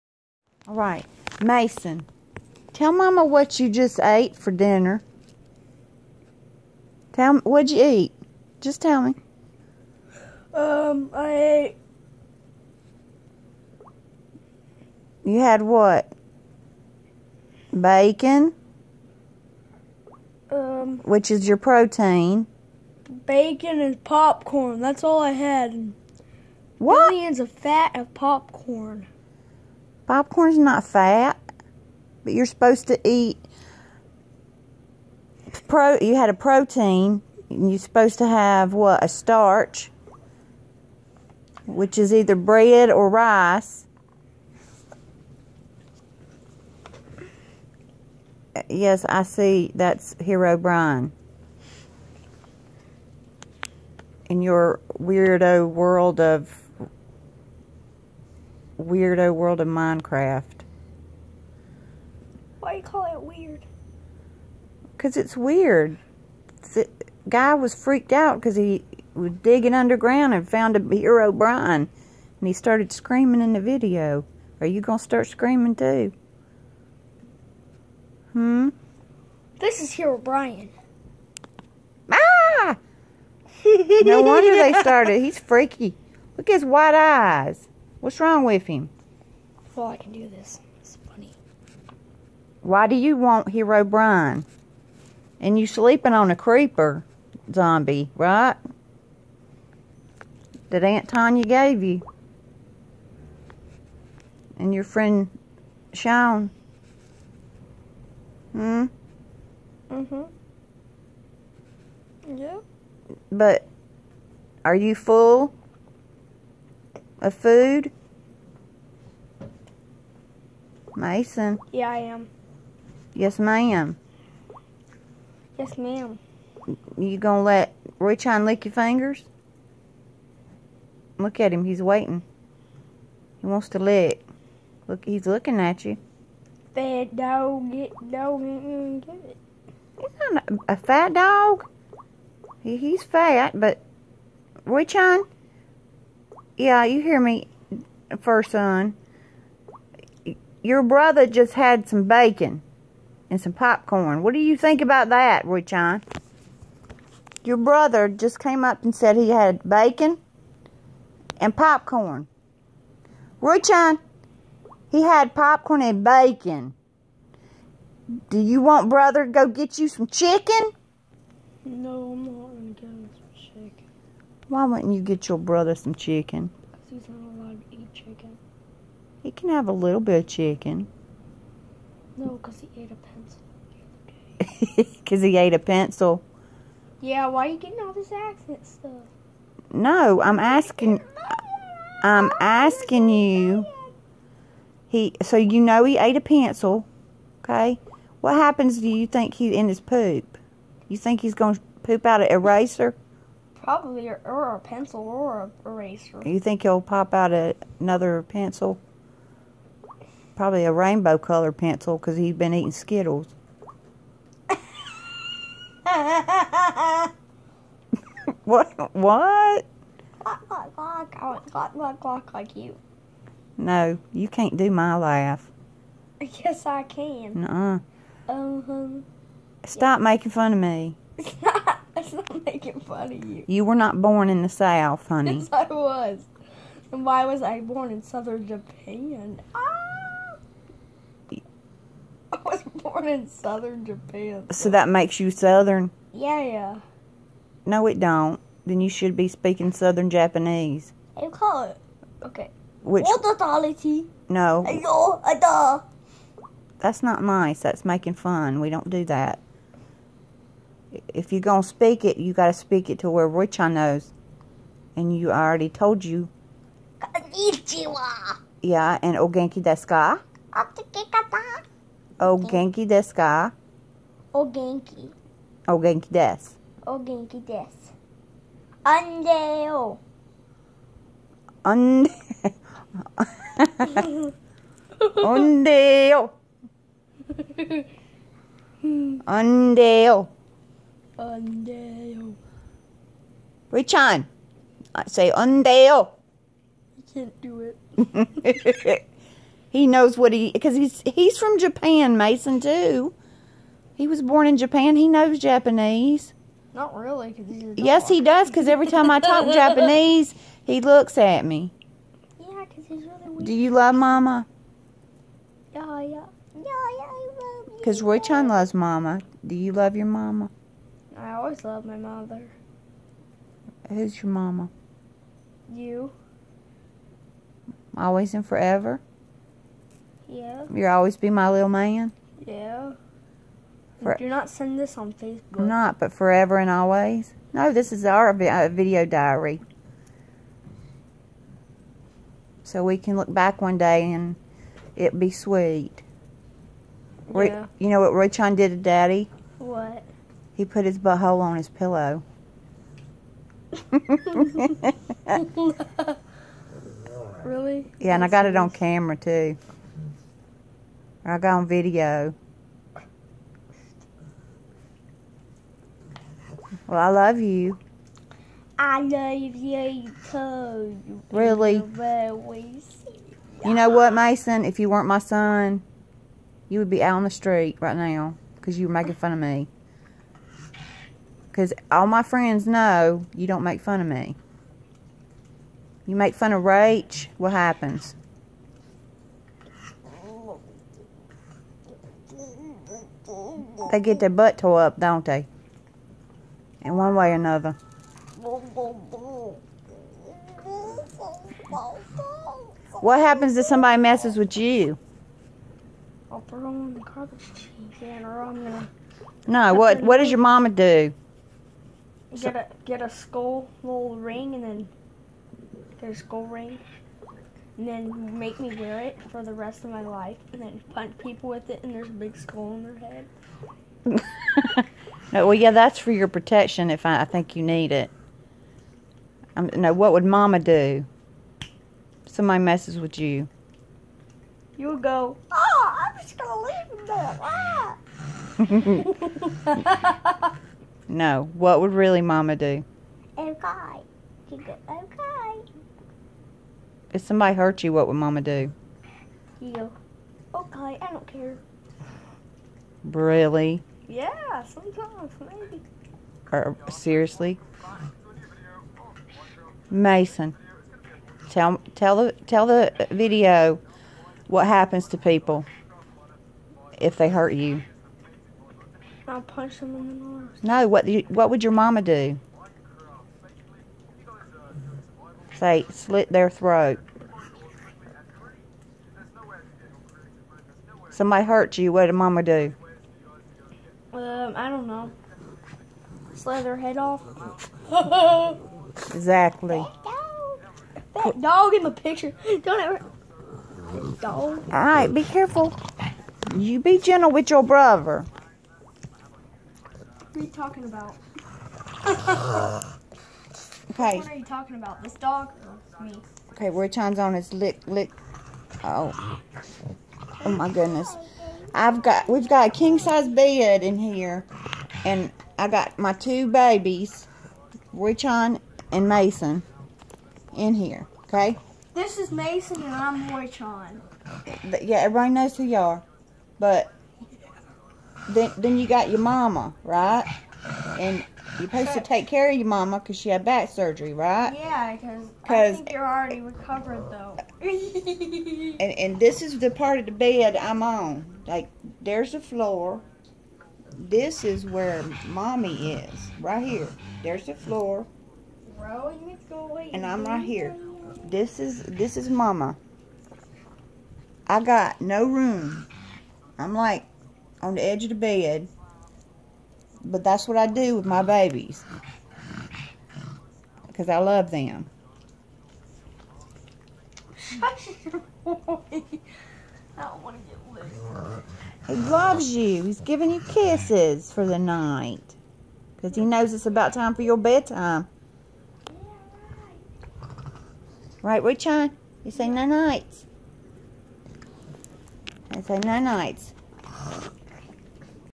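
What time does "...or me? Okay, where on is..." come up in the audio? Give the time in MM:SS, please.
08:25.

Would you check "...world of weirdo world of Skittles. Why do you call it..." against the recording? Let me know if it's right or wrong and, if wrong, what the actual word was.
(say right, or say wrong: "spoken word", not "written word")
wrong: "Minecraft", not "Skittles".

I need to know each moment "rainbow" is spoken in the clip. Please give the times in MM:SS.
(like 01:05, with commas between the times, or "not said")
03:30.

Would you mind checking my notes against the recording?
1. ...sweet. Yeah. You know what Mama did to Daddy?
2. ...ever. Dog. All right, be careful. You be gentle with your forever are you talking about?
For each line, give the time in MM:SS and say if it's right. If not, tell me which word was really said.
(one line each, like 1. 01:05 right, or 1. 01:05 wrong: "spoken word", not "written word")
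1. 05:45 wrong: "Roychon", not "Mama"
2. 08:12 wrong: "brother", not "forever".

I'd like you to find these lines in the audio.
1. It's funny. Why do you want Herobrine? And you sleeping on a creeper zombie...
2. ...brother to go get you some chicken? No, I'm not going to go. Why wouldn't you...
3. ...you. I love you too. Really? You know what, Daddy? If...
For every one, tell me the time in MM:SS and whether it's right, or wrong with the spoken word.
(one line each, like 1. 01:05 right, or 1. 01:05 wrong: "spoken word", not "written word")
1. 01:30 right
2. 02:48 right
3. 06:07 wrong: "Mason", not "Daddy".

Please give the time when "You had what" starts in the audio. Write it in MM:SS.
00:15.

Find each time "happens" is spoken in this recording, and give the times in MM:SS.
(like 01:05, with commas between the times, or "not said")
03:18, 06:27, 06:43, 07:44.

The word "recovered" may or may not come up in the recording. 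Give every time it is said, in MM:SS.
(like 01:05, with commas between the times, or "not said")
08:56.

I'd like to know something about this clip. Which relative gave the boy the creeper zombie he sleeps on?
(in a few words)
Aunt Tanya.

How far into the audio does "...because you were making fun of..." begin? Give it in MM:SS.
06:18.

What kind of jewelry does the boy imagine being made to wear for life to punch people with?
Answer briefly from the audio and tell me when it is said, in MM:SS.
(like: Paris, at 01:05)
A skull ring, at 06:56.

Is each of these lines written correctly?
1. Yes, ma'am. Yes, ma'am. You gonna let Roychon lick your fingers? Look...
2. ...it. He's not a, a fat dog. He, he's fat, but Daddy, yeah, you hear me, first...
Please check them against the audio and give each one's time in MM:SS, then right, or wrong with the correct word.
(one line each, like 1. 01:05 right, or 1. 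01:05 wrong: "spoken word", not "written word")
1. 02:03 right
2. 02:19 wrong: "Roychon", not "Daddy".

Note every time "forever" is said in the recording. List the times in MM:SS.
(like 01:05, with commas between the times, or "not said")
05:28, 05:36.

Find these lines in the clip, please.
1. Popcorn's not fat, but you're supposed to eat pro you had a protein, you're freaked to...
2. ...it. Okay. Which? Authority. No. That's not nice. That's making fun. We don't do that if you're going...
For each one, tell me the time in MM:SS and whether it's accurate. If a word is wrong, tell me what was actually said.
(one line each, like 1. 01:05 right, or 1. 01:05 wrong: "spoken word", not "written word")
1. 00:30 wrong: "supposed", not "freaked"
2. 04:11 right.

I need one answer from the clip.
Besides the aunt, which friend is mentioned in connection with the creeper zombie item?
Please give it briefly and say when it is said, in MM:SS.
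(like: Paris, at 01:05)
Sean, at 01:45.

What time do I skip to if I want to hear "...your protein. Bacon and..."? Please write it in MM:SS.
00:21.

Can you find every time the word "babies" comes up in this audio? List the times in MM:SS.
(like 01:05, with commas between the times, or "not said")
08:36, 09:21.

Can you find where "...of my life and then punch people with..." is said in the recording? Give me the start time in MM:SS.
06:59.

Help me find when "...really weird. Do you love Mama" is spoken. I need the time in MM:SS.
05:13.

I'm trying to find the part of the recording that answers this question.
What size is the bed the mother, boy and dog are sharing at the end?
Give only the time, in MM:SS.
08:32.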